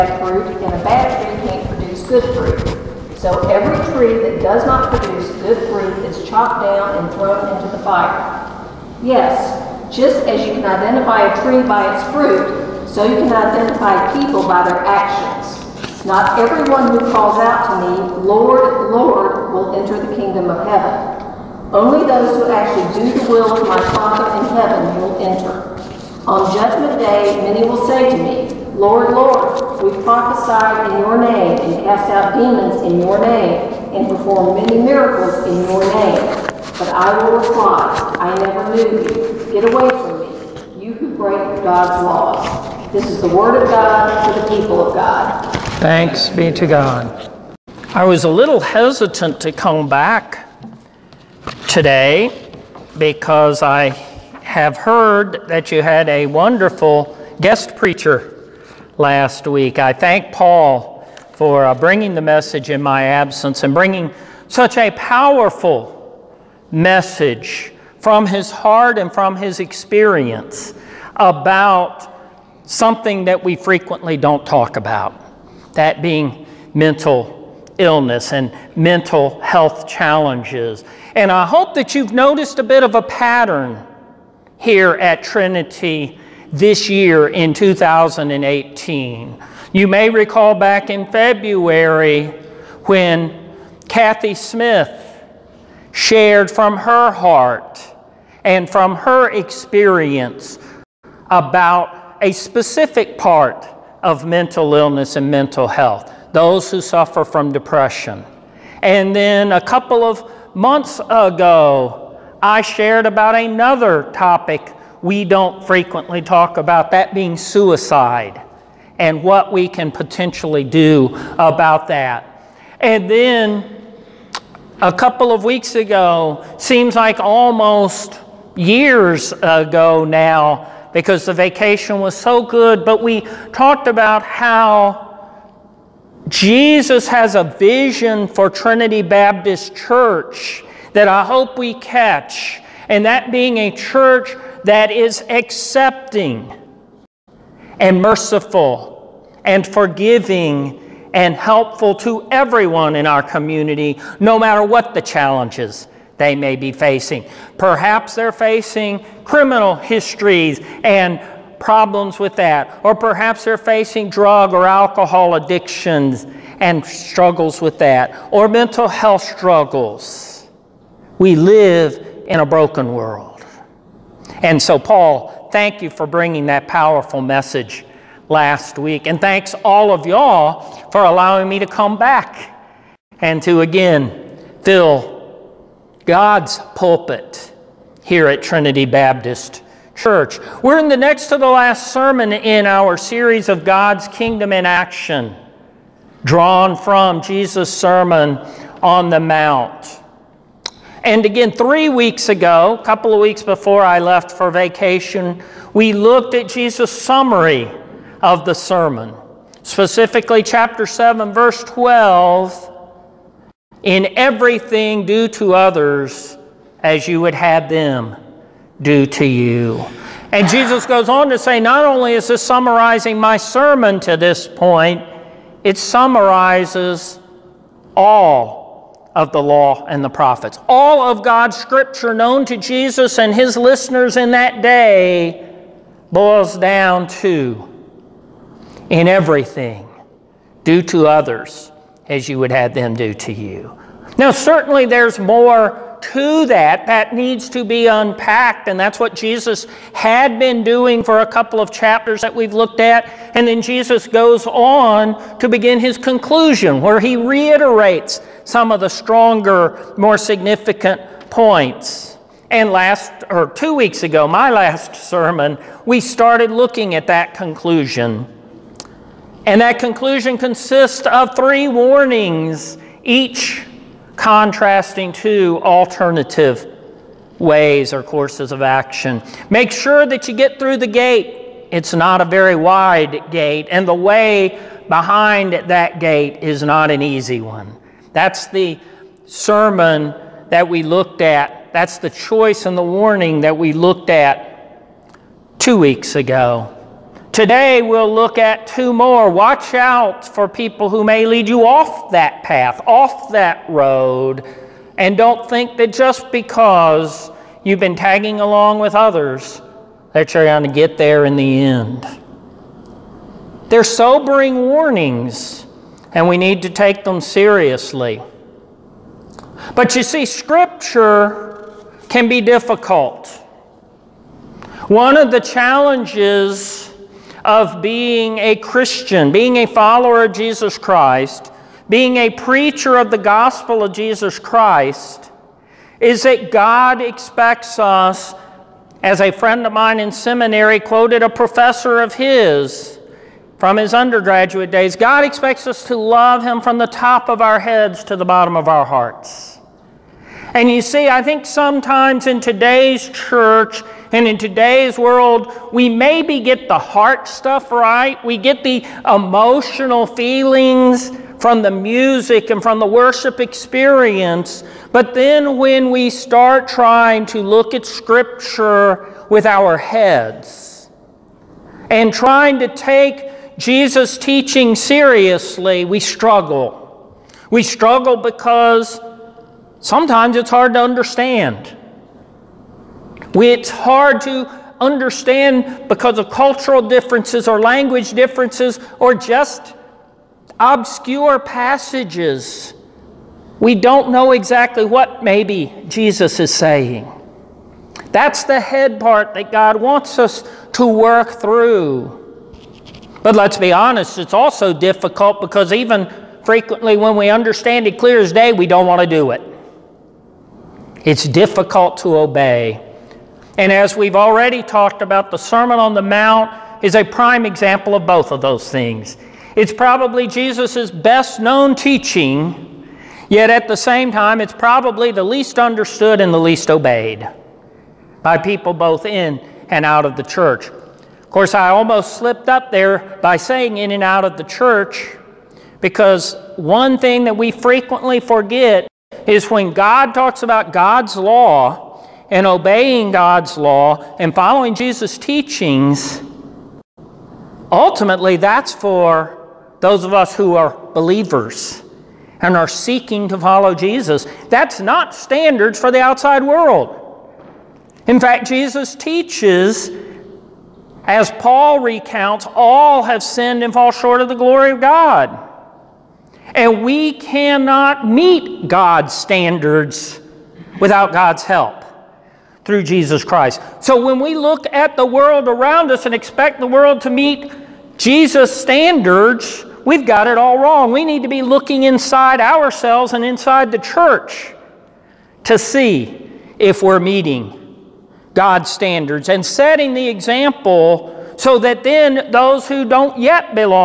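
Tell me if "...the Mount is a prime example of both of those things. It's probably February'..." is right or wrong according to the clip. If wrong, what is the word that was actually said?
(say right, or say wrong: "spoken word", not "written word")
wrong: "Jesus", not "February".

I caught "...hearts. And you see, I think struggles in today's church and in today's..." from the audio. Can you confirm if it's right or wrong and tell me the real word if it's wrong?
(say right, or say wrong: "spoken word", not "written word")
wrong: "sometimes", not "struggles".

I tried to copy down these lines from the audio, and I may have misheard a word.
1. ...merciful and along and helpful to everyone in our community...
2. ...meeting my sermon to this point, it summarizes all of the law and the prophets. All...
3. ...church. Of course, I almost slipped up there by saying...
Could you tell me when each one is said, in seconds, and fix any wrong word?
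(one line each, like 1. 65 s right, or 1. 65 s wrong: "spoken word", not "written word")
1. 148 s wrong: "forgiving", not "along"
2. 222 s wrong: "summarizing", not "meeting"
3. 430 s right.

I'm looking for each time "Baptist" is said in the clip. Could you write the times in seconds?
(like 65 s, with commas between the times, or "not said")
139 s, 188 s.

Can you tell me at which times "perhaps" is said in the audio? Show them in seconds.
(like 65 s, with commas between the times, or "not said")
157 s, 162 s.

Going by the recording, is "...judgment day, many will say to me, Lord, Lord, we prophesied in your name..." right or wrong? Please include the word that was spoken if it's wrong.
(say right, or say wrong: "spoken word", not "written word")
right.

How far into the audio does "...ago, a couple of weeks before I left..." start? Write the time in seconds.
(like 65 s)
202 s.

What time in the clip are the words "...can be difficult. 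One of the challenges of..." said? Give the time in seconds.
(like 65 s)
322 s.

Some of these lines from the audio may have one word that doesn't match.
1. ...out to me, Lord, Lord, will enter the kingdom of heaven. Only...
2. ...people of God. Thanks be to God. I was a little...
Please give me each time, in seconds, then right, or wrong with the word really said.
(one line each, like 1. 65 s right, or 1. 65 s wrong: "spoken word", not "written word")
1. 17 s right
2. 44 s right.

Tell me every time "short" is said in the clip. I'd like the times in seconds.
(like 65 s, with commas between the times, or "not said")
463 s.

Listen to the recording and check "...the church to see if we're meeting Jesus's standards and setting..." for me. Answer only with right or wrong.
wrong.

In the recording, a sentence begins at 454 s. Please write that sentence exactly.
That's not standards for the outside world.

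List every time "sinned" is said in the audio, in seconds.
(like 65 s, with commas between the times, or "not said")
463 s.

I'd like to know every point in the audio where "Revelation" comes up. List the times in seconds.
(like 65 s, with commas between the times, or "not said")
not said.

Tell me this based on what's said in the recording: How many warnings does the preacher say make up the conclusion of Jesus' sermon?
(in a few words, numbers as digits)
3.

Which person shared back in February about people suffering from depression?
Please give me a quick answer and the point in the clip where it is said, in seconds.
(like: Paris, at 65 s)
Kathy Smith, at 93 s.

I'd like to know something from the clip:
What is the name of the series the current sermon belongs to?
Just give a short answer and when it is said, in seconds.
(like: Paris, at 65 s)
God's Kingdom in Action, at 193 s.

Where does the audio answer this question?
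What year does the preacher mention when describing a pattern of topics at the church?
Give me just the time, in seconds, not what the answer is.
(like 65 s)
87 s.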